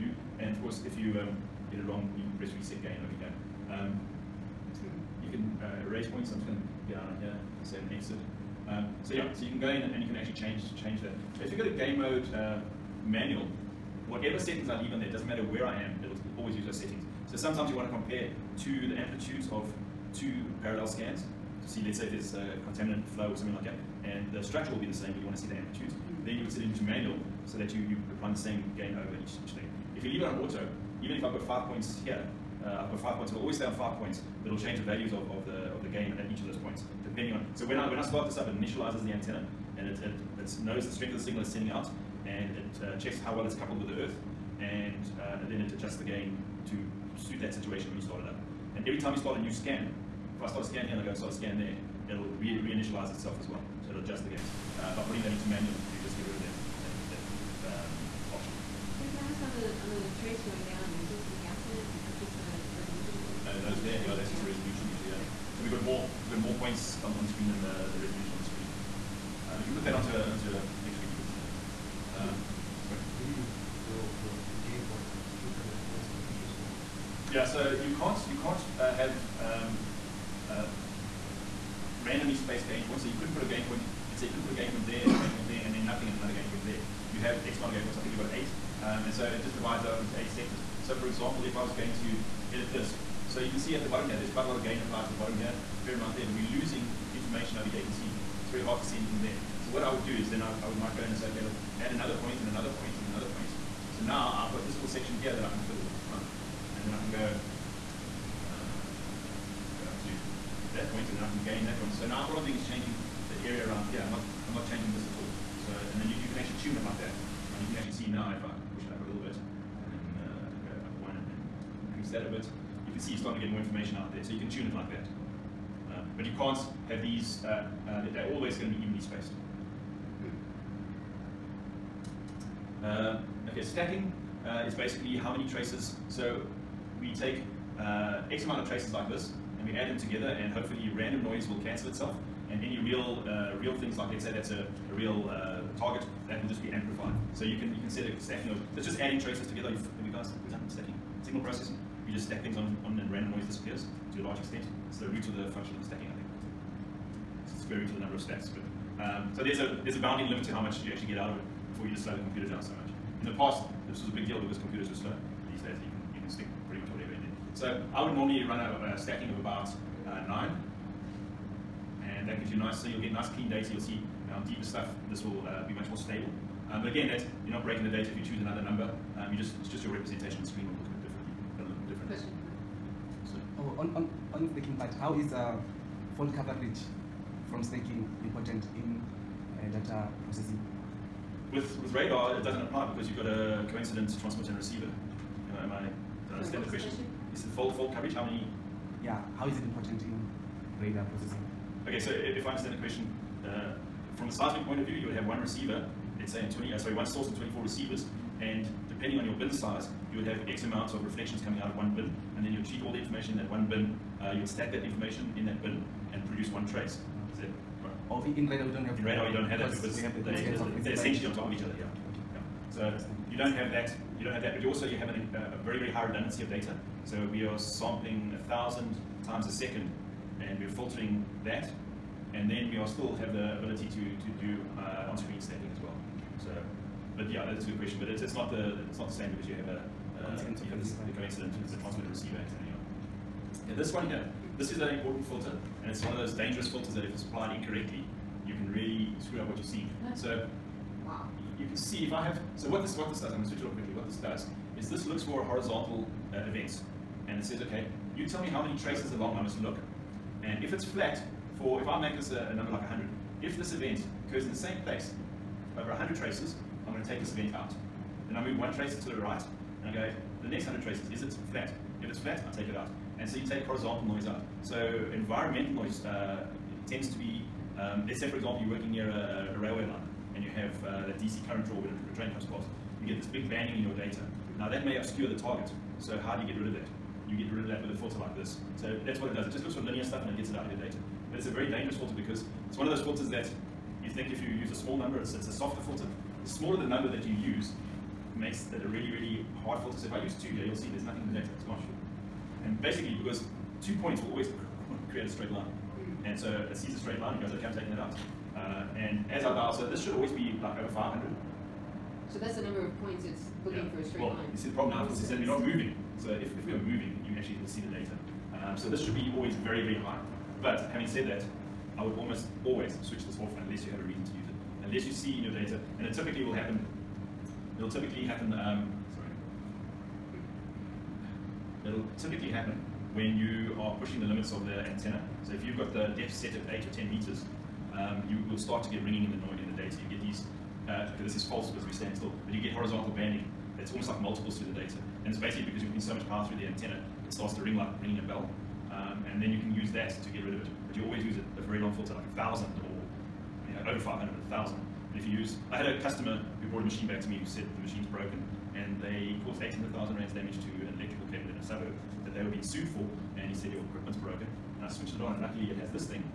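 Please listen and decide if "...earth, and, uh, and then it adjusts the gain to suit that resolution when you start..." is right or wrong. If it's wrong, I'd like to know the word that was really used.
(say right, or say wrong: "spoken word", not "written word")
wrong: "situation", not "resolution".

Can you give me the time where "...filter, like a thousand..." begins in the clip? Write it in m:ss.
5:51.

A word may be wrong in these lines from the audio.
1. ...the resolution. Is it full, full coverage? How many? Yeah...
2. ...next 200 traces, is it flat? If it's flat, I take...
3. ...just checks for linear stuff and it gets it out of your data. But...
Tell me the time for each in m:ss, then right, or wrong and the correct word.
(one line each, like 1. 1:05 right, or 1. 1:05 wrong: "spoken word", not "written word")
1. 3:16 wrong: "question", not "resolution"
2. 4:30 wrong: "100", not "200"
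3. 4:49 wrong: "looks", not "checks".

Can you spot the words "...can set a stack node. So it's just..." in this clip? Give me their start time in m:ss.
2:27.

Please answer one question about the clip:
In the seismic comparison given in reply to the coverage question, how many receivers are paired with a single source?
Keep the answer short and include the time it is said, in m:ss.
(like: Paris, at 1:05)
24, at 3:27.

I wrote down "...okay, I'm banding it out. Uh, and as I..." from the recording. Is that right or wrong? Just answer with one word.
wrong.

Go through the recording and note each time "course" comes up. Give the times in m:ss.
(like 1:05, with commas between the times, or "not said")
0:00, 5:15.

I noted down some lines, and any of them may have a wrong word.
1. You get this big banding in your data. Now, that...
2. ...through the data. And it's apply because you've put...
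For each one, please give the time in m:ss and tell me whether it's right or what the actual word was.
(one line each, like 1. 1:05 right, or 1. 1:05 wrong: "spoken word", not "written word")
1. 4:43 right
2. 5:44 wrong: "basically", not "apply".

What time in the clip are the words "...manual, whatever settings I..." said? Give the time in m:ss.
0:13.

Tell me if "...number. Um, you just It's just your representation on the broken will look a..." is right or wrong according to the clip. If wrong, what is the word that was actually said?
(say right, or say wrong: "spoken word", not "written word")
wrong: "screen", not "broken".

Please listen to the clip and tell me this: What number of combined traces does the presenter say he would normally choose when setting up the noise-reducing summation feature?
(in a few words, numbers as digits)
9.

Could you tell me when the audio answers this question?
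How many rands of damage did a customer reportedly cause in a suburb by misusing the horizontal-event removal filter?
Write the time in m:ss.
5:59.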